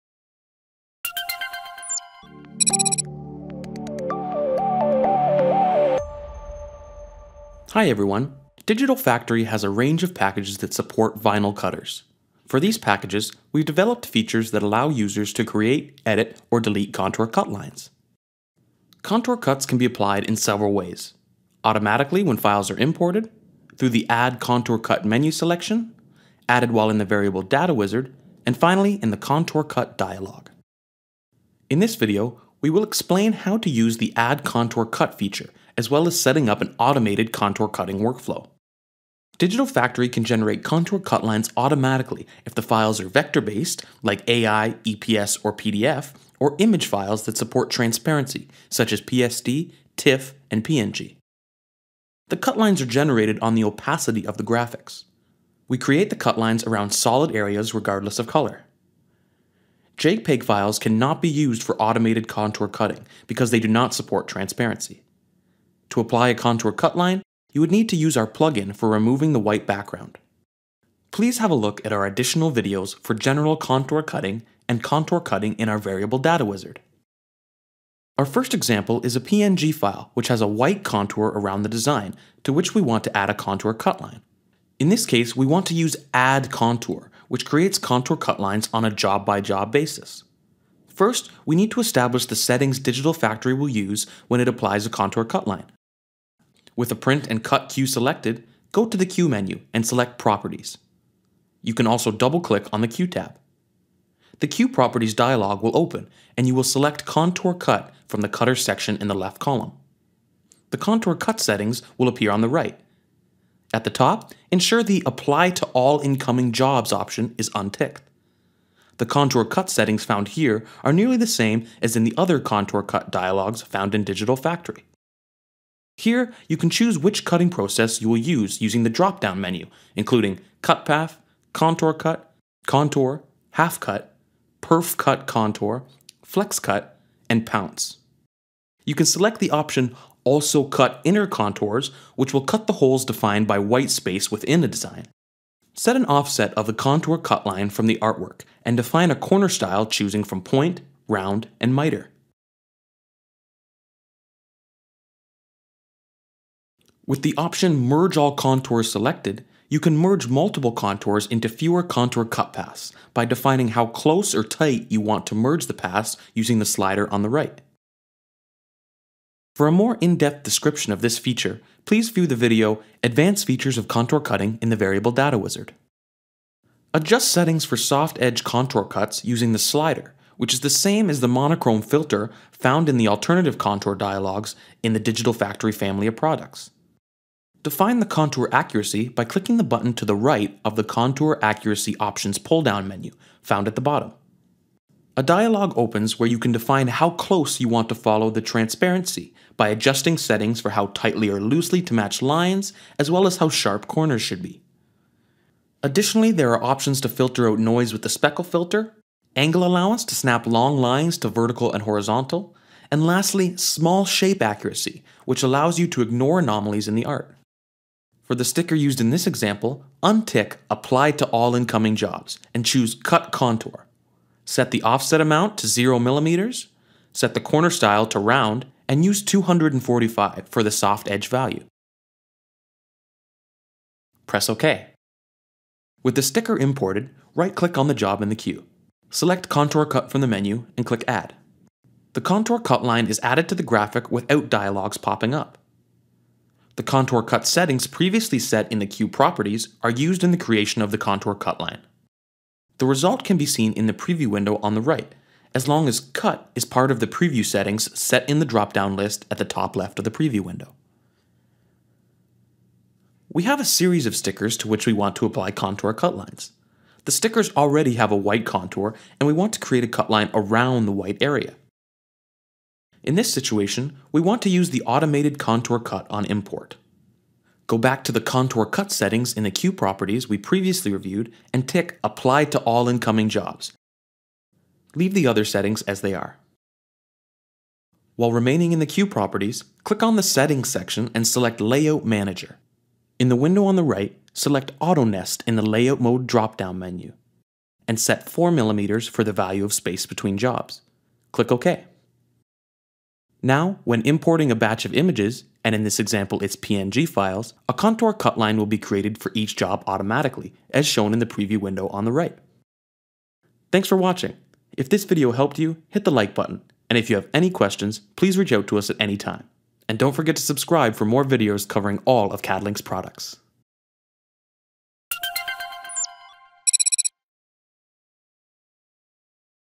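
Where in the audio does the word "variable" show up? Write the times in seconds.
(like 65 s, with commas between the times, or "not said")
27 s, 75 s, 174 s.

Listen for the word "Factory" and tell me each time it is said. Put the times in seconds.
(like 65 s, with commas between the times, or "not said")
8 s, 39 s, 93 s, 124 s, 185 s.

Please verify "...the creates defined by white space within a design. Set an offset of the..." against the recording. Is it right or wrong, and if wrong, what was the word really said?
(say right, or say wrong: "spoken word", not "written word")
wrong: "holes", not "creates".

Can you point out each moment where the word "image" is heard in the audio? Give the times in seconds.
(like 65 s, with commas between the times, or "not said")
46 s, 304 s.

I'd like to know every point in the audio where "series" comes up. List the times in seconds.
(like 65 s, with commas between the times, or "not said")
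263 s.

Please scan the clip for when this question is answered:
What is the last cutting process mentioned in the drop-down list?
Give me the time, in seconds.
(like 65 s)
137 s.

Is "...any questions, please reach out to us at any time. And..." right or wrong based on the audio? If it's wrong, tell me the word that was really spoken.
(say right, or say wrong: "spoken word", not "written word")
right.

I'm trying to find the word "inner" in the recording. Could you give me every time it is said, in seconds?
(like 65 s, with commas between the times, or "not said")
141 s.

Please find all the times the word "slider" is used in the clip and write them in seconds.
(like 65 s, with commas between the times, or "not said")
166 s, 179 s.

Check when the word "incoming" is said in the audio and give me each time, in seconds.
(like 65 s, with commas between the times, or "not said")
115 s, 221 s, 282 s.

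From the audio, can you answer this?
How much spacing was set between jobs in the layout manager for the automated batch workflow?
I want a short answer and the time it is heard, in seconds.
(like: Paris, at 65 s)
4mm, at 298 s.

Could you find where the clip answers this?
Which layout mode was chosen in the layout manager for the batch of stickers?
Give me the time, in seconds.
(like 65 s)
294 s.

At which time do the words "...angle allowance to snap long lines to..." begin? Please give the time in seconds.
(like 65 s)
209 s.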